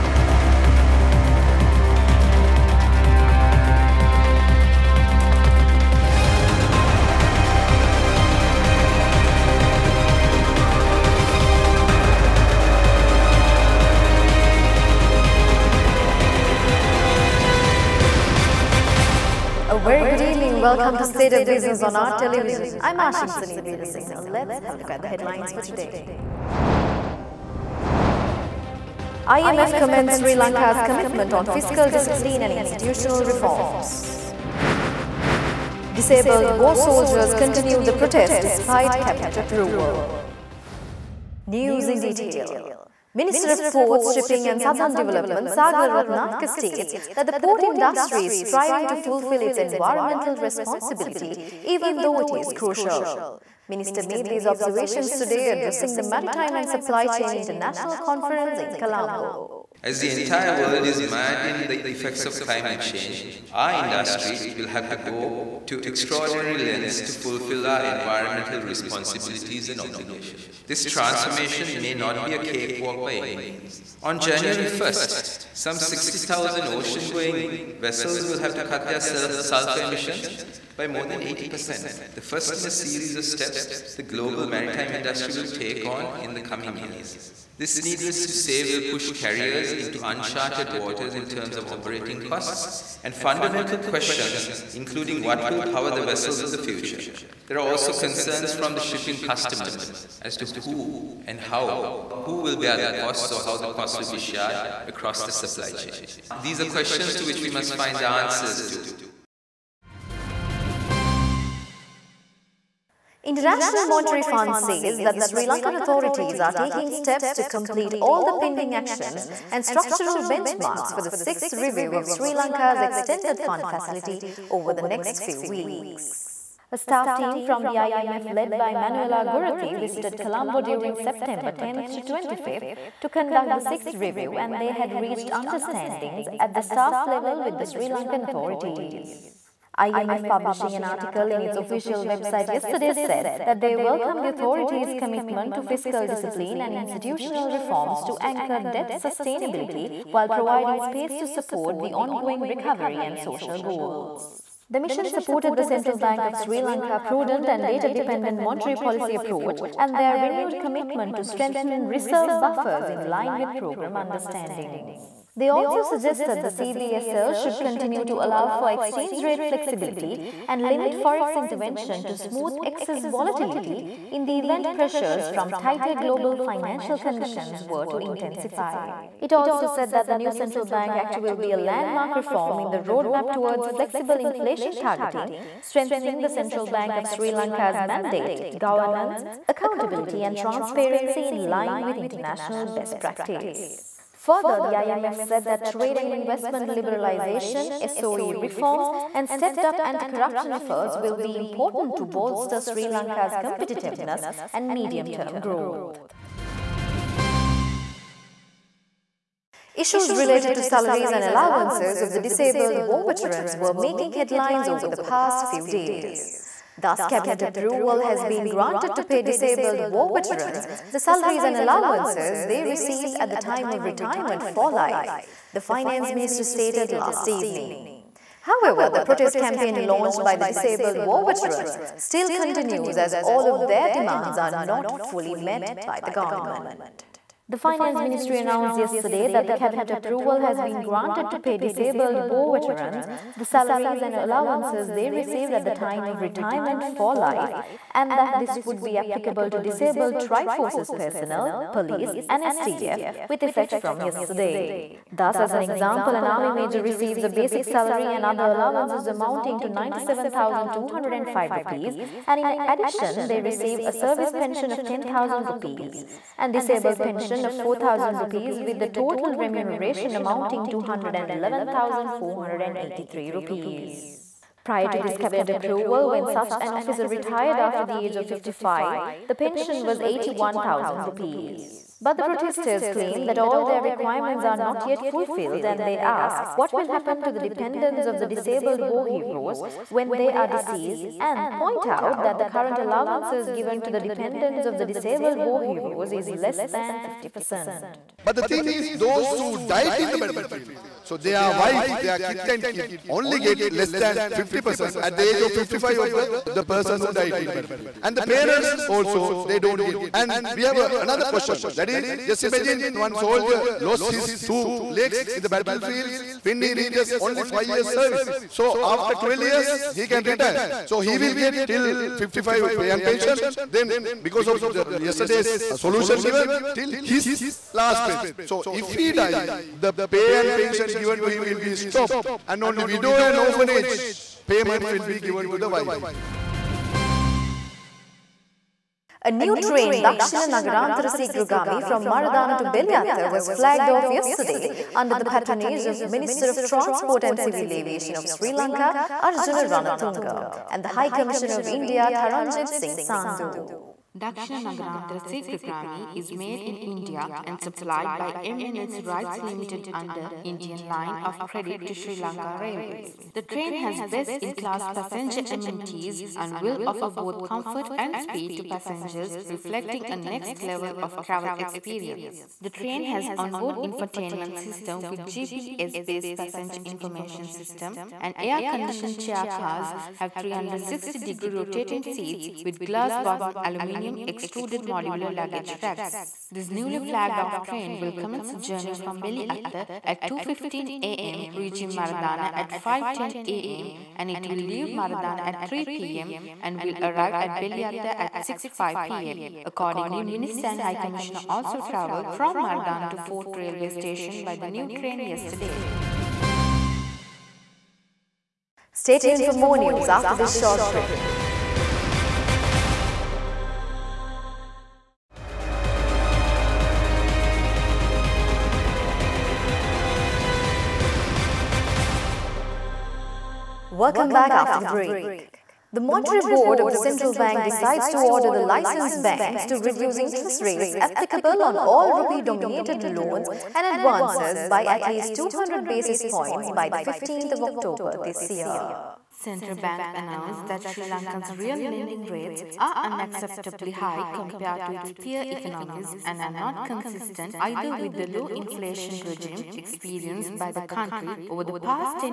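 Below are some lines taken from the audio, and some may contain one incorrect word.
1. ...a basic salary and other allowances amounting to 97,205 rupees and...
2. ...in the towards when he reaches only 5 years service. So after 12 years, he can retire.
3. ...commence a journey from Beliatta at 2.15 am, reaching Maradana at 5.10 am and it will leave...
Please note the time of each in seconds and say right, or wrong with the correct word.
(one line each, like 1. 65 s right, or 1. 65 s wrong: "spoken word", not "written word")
1. 257 s right
2. 315 s wrong: "battlefields", not "towards"
3. 388 s right.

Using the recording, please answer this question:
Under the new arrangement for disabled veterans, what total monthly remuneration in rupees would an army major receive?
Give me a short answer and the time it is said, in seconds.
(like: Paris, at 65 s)
111,483 rupees, at 270 s.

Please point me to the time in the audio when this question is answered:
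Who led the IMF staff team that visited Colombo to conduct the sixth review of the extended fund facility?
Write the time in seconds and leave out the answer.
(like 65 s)
128 s.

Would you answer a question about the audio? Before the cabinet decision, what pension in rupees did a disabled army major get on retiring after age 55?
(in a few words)
81,000 rupees.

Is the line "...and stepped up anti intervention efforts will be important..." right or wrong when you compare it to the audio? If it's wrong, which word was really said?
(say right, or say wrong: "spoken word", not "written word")
wrong: "corruption", not "intervention".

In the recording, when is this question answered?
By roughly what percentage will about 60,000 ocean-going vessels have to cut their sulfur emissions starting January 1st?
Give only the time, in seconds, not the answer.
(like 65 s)
80 s.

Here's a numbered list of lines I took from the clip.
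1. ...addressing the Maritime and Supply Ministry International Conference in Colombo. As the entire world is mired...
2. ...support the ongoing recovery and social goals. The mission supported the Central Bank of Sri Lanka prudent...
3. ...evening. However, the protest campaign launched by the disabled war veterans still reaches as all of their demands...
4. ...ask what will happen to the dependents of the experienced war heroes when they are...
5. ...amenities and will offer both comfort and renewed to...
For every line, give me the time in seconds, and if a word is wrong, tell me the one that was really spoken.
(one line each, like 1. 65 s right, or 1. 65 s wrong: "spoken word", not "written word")
1. 55 s wrong: "Chain", not "Ministry"
2. 151 s right
3. 227 s wrong: "continues", not "reaches"
4. 285 s wrong: "disabled", not "experienced"
5. 365 s wrong: "speed", not "renewed".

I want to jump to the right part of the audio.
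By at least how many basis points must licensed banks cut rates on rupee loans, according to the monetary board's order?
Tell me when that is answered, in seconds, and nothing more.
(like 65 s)
435 s.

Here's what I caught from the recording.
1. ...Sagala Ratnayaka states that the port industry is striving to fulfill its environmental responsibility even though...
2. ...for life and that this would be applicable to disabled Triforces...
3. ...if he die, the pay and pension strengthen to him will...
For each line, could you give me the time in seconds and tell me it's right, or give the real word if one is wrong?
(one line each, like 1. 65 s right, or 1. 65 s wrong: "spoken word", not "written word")
1. 45 s right
2. 246 s right
3. 328 s wrong: "given", not "strengthen".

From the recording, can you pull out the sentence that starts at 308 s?
And the parents also, they don't get.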